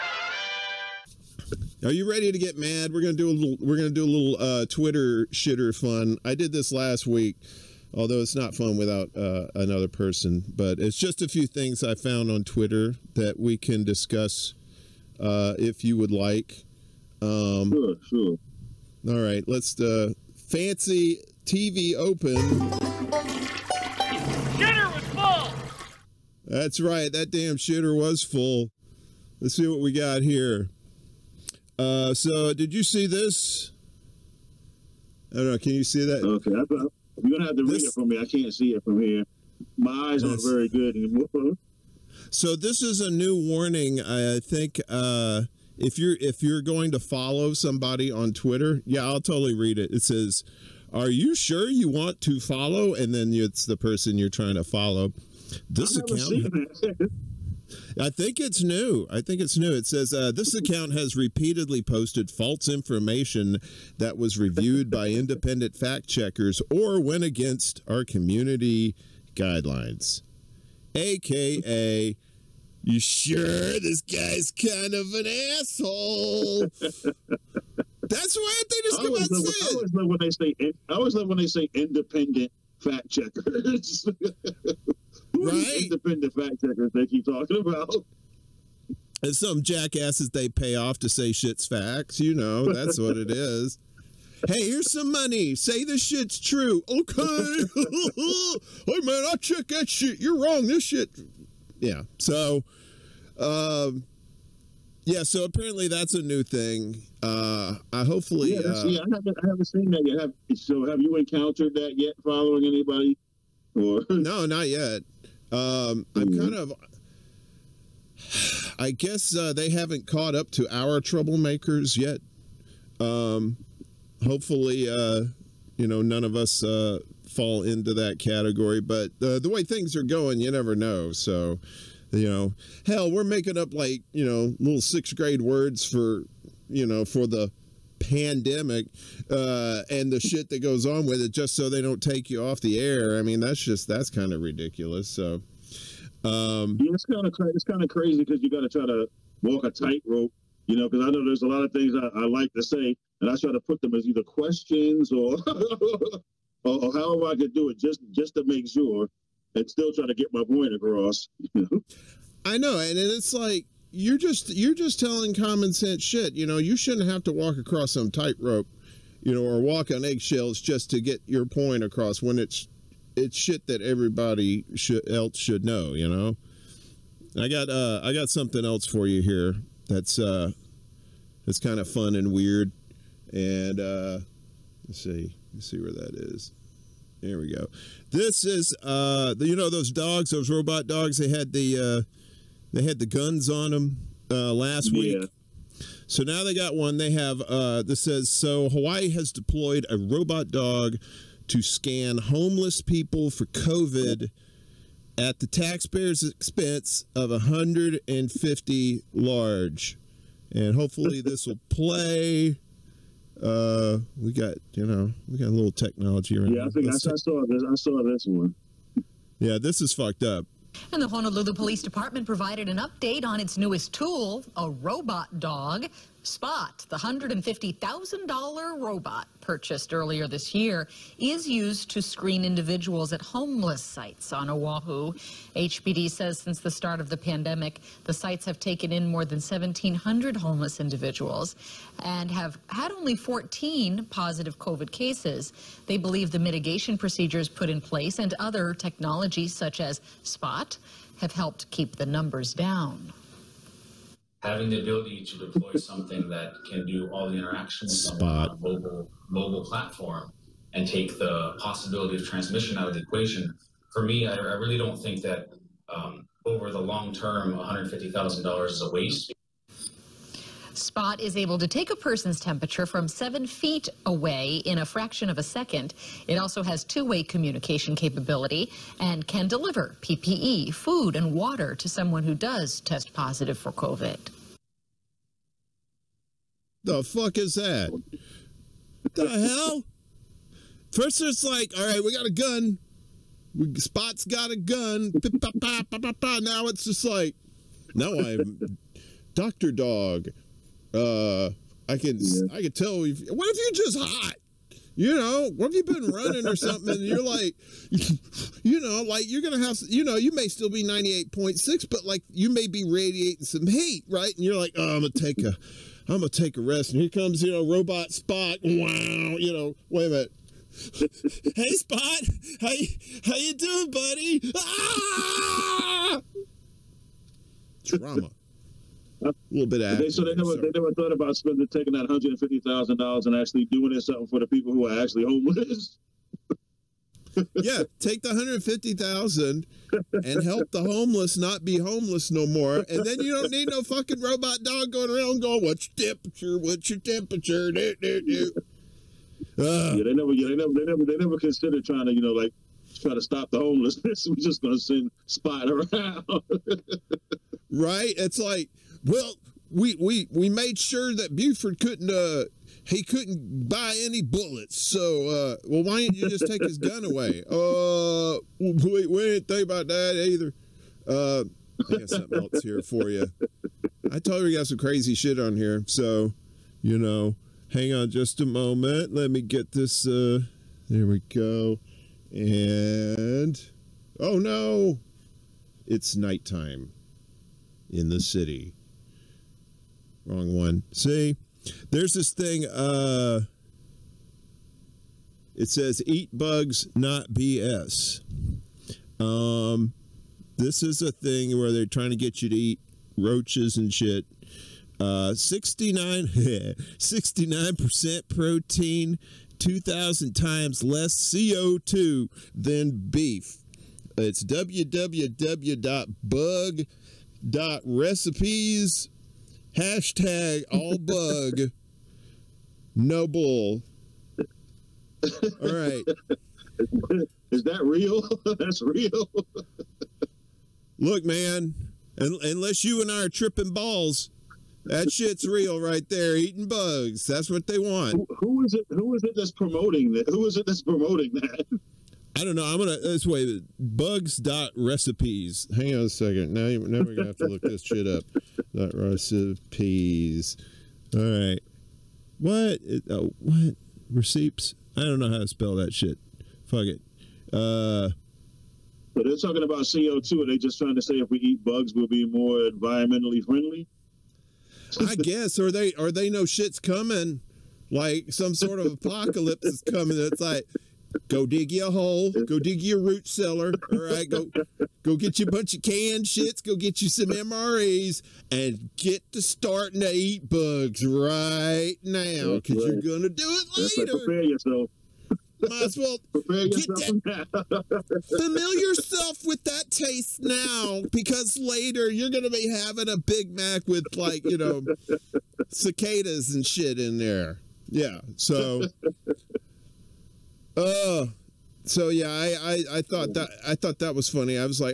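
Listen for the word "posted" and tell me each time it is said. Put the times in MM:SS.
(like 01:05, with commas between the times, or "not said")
01:01.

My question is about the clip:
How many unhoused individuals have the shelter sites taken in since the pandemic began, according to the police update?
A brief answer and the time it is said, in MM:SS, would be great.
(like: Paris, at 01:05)
1,700, at 03:59.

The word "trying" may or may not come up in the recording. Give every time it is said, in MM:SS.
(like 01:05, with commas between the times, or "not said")
00:54, 05:51, 06:41, 07:40.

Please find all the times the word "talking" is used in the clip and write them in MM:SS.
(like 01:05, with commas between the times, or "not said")
01:27, 07:39.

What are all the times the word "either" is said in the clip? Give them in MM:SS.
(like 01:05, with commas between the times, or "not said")
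02:34, 06:10.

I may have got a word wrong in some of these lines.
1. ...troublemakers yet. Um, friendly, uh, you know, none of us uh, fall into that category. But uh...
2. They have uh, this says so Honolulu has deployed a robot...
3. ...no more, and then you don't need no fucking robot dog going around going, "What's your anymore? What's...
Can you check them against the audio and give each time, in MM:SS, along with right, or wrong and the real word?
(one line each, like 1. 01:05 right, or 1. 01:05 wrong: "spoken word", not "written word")
1. 02:00 wrong: "hopefully", not "friendly"
2. 03:16 wrong: "Hawaii", not "Honolulu"
3. 05:42 wrong: "temperature", not "anymore".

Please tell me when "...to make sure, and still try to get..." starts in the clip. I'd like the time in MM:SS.
02:38.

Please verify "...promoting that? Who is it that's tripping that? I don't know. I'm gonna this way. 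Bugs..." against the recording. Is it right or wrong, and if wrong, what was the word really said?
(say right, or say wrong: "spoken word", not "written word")
wrong: "promoting", not "tripping".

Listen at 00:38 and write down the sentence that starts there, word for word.
I can't see it from here.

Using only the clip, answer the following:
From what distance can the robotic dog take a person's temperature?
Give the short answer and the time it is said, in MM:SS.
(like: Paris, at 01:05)
7 feet, at 04:33.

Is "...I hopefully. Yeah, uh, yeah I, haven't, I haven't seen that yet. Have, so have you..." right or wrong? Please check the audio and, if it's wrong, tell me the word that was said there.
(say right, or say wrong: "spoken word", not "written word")
right.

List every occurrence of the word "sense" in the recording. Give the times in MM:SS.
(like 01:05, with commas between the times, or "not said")
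02:45.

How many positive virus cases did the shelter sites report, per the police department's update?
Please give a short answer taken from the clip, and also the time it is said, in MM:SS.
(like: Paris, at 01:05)
14, at 04:03.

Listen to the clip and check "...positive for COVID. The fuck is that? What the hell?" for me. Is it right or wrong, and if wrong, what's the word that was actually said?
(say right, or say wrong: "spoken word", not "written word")
right.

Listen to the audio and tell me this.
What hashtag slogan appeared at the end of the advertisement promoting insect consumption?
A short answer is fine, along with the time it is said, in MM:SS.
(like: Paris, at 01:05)
all bug, no bull, at 07:00.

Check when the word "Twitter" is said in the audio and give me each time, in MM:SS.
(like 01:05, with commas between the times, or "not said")
00:04, 00:12, 00:48.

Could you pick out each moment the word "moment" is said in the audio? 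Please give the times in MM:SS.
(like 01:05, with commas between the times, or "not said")
06:18.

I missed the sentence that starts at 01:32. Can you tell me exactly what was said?
You know, that's what it is.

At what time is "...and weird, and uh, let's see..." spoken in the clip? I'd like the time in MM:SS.
03:02.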